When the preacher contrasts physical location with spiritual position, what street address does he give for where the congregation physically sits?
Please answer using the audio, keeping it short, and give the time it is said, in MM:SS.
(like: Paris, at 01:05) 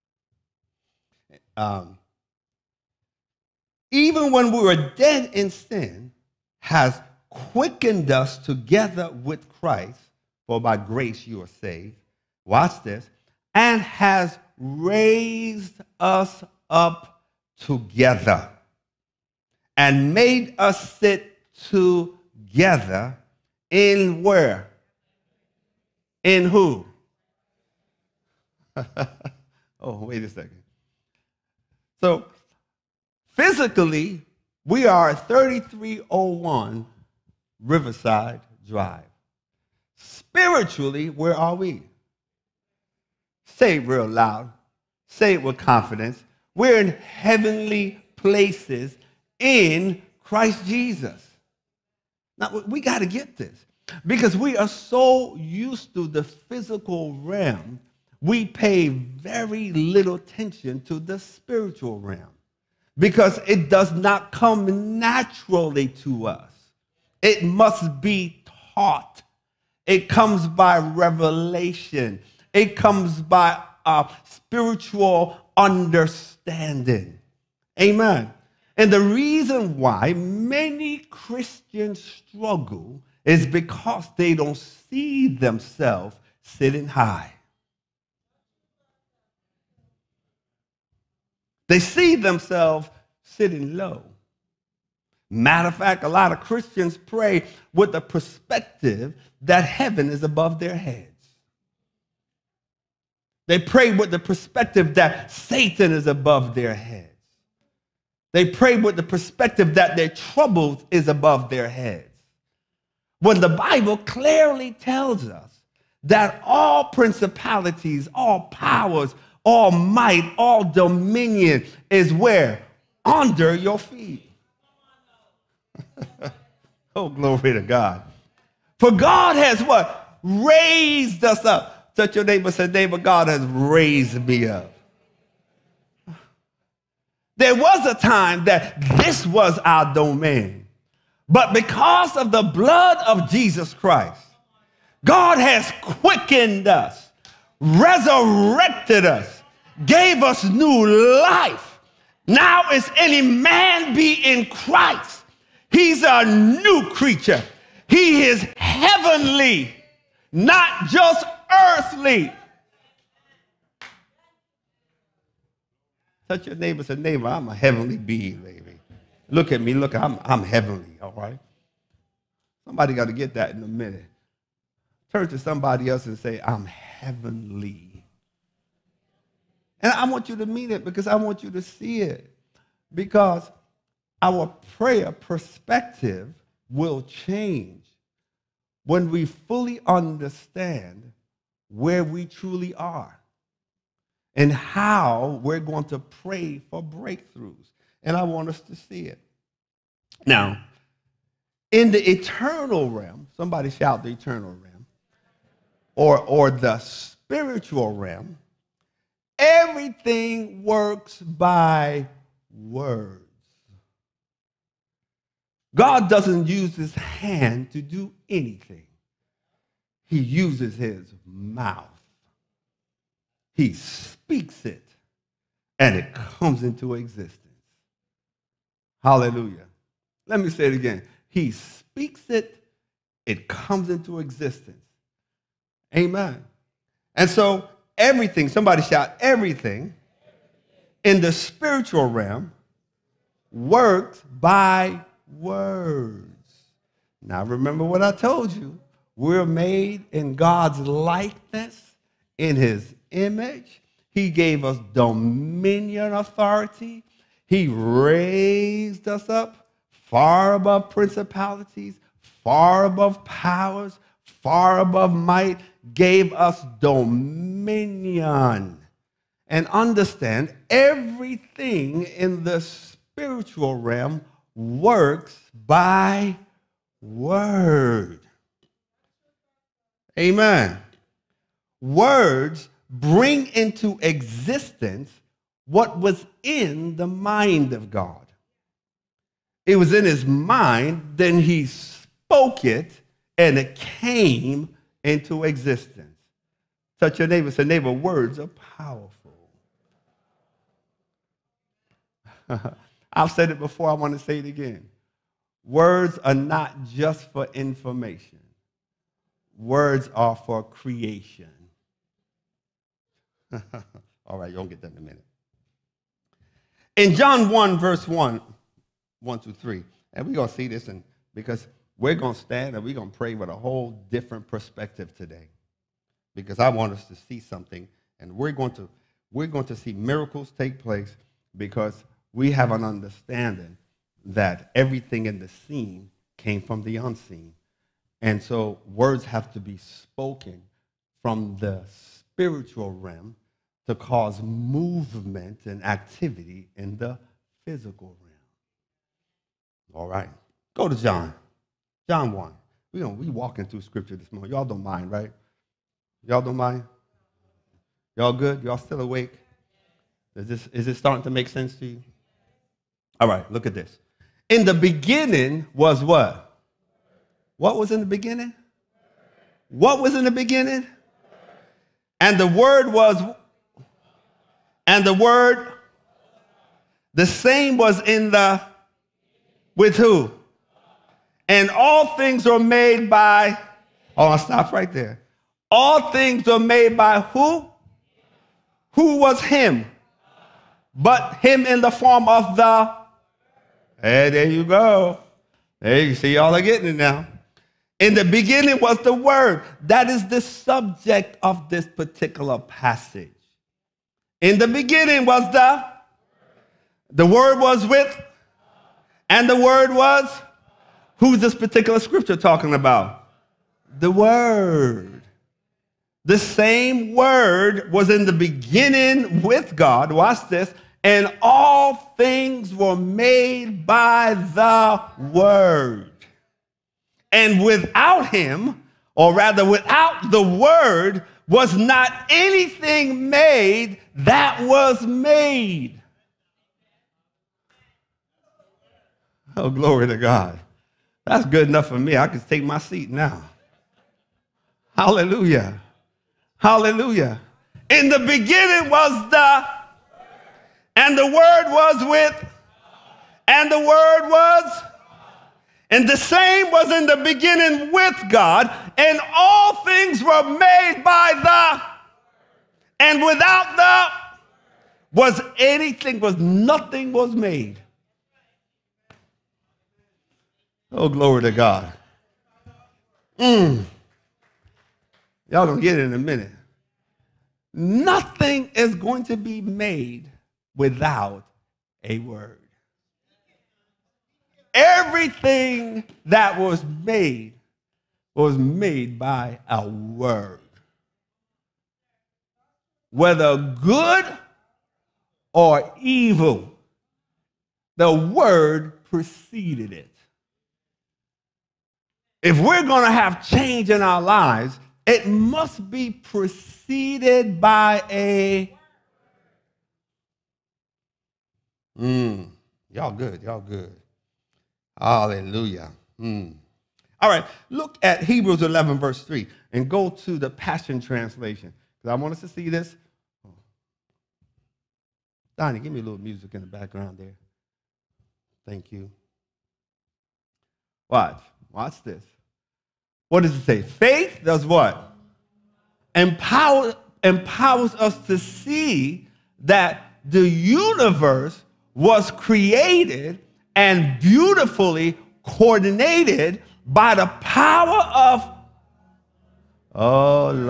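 3301 Riverside Drive, at 00:35.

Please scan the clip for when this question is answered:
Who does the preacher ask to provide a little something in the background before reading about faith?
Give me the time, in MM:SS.
08:45.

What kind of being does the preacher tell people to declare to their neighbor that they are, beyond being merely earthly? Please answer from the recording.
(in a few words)
Heavenly being.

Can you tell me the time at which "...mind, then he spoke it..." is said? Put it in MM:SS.
04:50.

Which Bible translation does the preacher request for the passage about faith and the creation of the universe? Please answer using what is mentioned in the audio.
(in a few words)
Passion Translation.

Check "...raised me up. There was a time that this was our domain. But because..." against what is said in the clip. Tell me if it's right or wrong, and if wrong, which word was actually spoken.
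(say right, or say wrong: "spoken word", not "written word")
right.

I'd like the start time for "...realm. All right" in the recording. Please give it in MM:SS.
05:48.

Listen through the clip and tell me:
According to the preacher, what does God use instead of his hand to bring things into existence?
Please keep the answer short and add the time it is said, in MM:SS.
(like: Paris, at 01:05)
His mouth, at 03:40.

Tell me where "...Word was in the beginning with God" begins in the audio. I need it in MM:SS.
06:57.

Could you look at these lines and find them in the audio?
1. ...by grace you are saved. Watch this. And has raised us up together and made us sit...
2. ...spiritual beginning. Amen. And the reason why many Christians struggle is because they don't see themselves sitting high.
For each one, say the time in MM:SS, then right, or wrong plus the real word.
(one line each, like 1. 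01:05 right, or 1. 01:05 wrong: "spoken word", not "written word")
1. 00:10 right
2. 01:14 wrong: "understanding", not "beginning".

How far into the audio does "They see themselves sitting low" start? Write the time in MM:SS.
01:31.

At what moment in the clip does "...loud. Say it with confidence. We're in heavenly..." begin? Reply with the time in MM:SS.
00:44.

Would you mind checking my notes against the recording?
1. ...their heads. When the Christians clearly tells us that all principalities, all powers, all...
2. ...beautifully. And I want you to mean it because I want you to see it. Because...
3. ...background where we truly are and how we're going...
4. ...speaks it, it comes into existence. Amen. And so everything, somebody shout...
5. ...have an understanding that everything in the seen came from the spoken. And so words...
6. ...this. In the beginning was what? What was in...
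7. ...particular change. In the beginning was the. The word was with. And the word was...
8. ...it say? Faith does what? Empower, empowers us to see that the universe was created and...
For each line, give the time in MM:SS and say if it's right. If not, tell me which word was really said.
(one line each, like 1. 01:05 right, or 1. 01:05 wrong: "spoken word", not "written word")
1. 01:51 wrong: "Bible", not "Christians"
2. 02:56 wrong: "heavenly", not "beautifully"
3. 03:09 wrong: "understand", not "background"
4. 03:51 right
5. 05:32 wrong: "unseen", not "spoken"
6. 06:03 right
7. 06:41 wrong: "passage", not "change"
8. 08:53 right.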